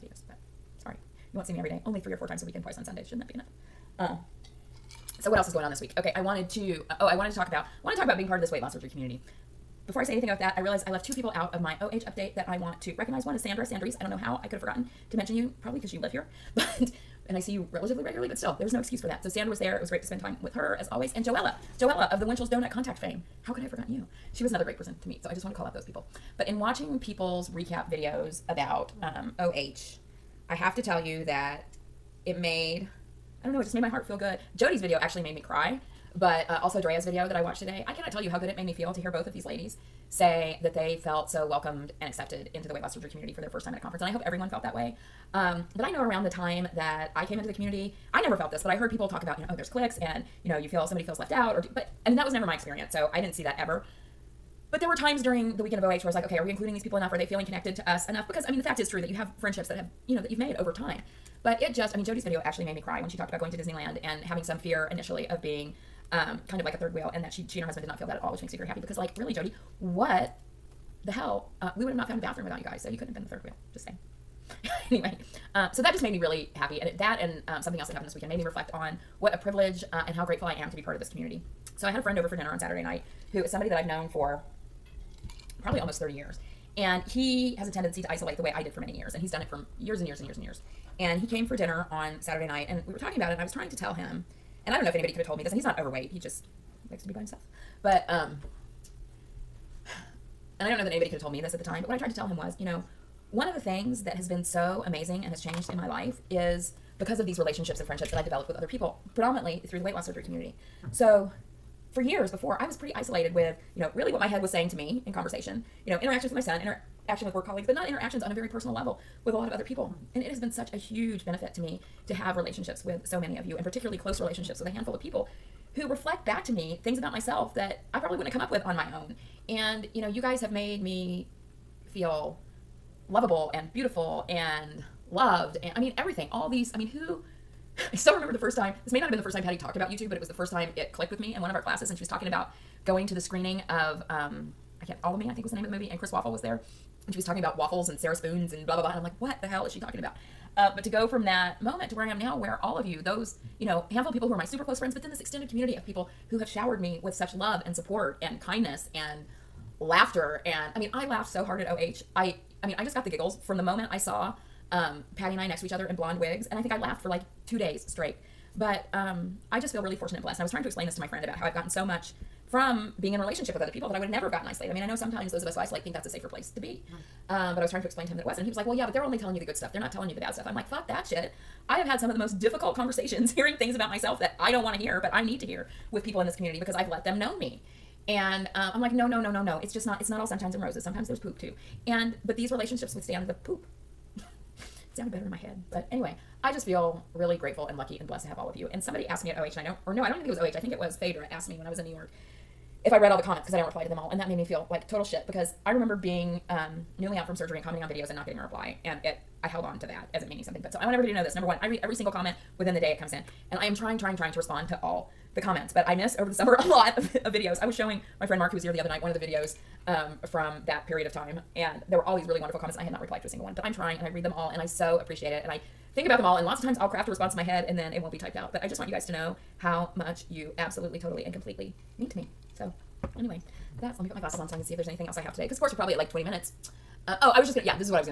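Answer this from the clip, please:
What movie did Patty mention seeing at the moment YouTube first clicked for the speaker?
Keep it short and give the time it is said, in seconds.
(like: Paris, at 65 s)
All of Me, at 145 s.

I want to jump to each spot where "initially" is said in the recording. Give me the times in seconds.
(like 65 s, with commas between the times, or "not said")
64 s.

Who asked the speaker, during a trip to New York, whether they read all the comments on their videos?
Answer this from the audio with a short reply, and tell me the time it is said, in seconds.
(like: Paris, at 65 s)
Phaedra, at 201 s.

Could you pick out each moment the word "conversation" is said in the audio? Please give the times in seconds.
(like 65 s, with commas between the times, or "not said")
115 s, 182 s.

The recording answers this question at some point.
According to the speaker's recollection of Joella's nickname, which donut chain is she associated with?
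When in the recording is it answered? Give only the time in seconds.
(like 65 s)
22 s.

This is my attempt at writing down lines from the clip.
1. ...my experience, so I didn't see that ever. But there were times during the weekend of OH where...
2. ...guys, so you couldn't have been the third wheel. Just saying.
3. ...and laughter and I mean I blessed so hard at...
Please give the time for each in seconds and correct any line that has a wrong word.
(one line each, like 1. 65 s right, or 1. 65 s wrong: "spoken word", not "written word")
1. 52 s right
2. 72 s right
3. 158 s wrong: "laughed", not "blessed".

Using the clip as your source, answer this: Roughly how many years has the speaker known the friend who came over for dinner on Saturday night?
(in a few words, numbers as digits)
30.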